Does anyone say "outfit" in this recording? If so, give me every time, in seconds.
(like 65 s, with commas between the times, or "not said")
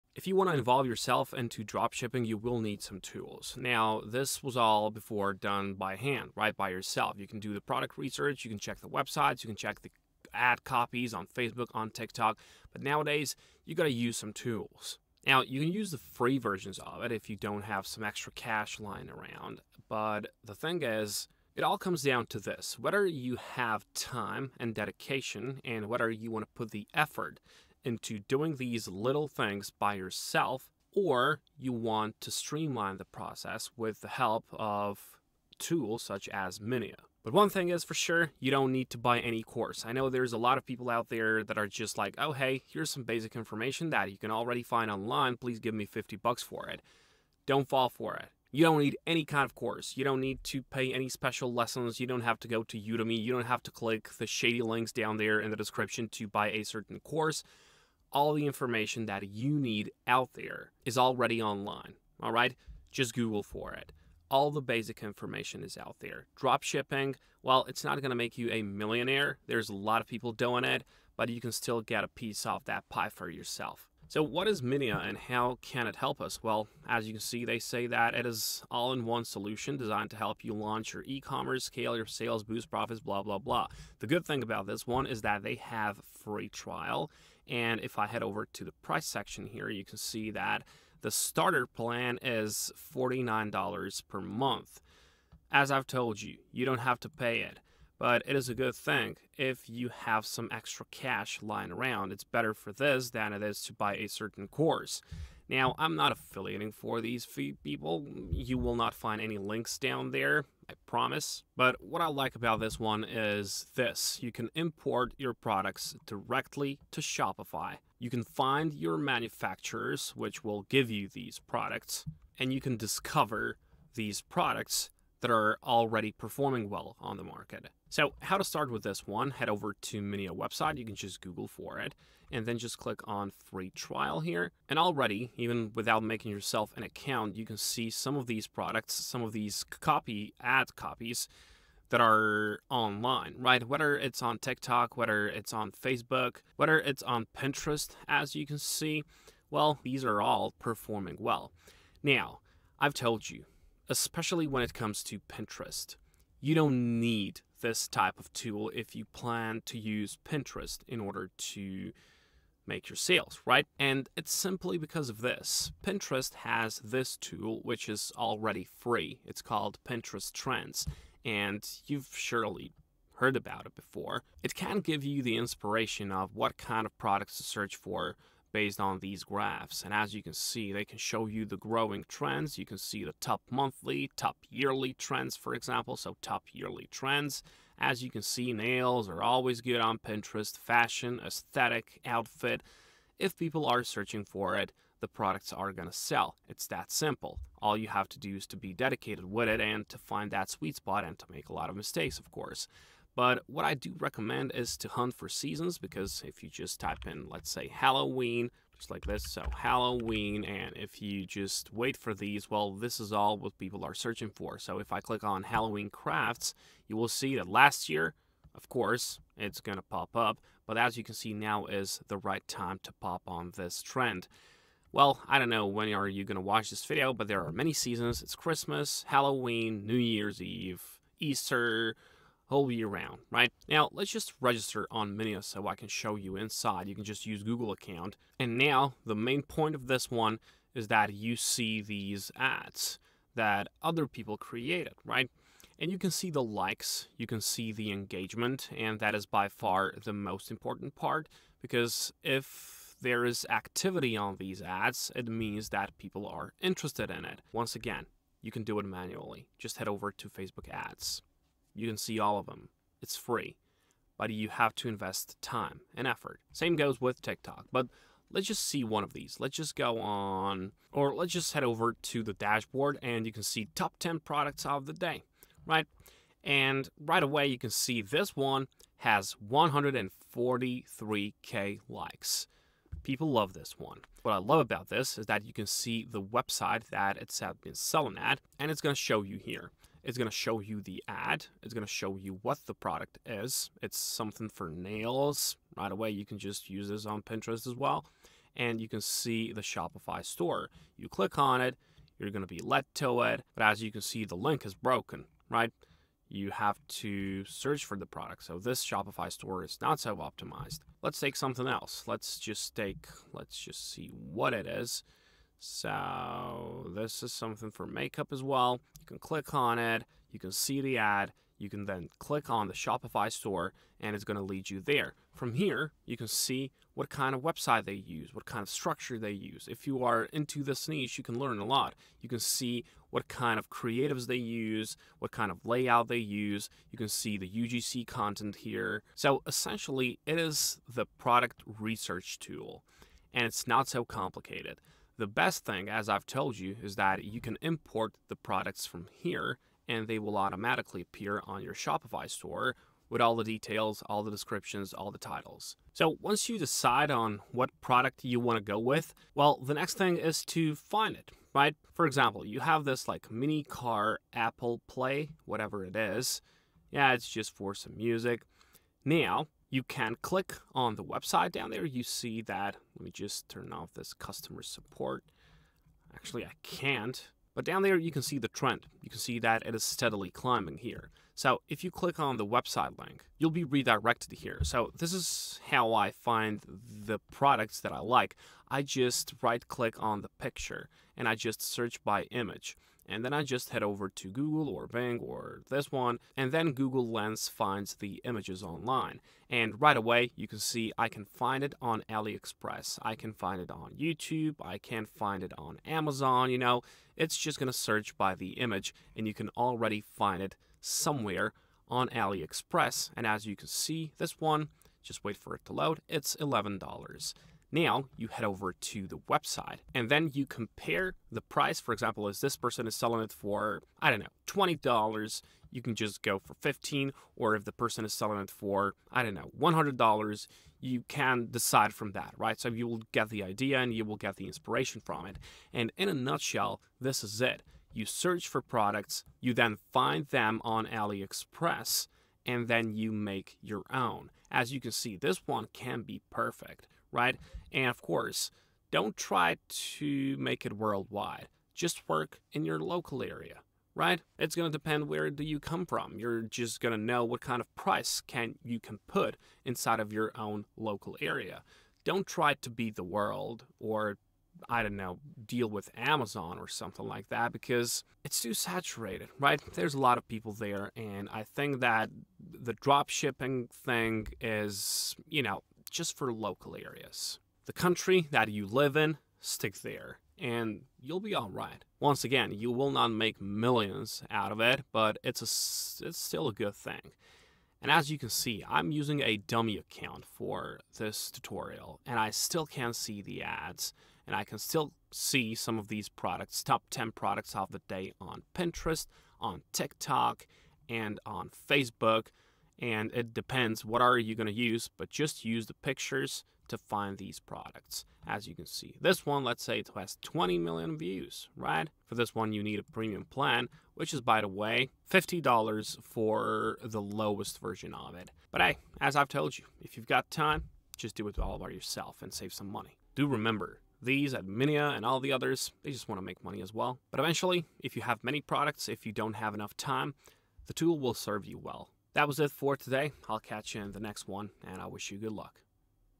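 192 s.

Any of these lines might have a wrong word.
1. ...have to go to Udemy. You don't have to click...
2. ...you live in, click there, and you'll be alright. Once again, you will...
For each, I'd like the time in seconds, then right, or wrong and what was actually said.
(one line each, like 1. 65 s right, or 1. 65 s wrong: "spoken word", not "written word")
1. 52 s right
2. 478 s wrong: "stick", not "click".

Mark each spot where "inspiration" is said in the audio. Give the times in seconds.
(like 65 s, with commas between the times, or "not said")
175 s, 434 s.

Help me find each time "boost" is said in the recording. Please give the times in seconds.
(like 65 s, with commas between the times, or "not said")
82 s.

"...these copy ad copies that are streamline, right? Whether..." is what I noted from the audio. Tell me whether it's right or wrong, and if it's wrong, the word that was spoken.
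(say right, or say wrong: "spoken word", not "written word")
wrong: "online", not "streamline".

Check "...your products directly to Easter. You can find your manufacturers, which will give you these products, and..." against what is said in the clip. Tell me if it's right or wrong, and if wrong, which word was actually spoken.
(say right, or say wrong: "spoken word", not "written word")
wrong: "Shopify", not "Easter".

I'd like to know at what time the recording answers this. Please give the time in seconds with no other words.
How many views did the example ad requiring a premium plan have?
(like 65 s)
510 s.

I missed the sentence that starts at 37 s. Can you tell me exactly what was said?
But one thing is for sure, you don't need to buy any course.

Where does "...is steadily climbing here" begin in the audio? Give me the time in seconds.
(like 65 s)
379 s.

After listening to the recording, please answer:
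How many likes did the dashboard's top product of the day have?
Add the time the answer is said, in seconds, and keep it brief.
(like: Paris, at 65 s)
143k, at 279 s.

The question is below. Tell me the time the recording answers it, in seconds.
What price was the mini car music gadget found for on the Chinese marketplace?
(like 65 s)
416 s.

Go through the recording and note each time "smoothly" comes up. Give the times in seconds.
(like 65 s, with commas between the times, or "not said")
not said.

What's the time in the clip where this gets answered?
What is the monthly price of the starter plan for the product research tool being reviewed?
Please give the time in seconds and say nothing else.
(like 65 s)
92 s.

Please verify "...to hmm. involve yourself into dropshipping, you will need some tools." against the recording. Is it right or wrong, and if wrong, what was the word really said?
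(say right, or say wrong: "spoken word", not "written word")
right.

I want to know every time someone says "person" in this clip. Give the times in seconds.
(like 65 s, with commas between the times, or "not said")
422 s, 427 s.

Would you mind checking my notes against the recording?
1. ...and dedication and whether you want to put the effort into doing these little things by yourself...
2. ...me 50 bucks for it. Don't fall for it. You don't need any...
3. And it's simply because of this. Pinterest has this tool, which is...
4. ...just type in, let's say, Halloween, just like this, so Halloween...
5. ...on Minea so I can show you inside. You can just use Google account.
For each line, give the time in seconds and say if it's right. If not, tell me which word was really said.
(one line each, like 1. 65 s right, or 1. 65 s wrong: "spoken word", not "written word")
1. 24 s right
2. 45 s right
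3. 163 s right
4. 206 s right
5. 234 s right.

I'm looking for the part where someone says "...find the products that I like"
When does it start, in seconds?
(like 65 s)
386 s.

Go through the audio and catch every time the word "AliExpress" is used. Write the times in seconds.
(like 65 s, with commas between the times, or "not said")
402 s, 412 s, 440 s.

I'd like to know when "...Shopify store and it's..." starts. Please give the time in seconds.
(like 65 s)
322 s.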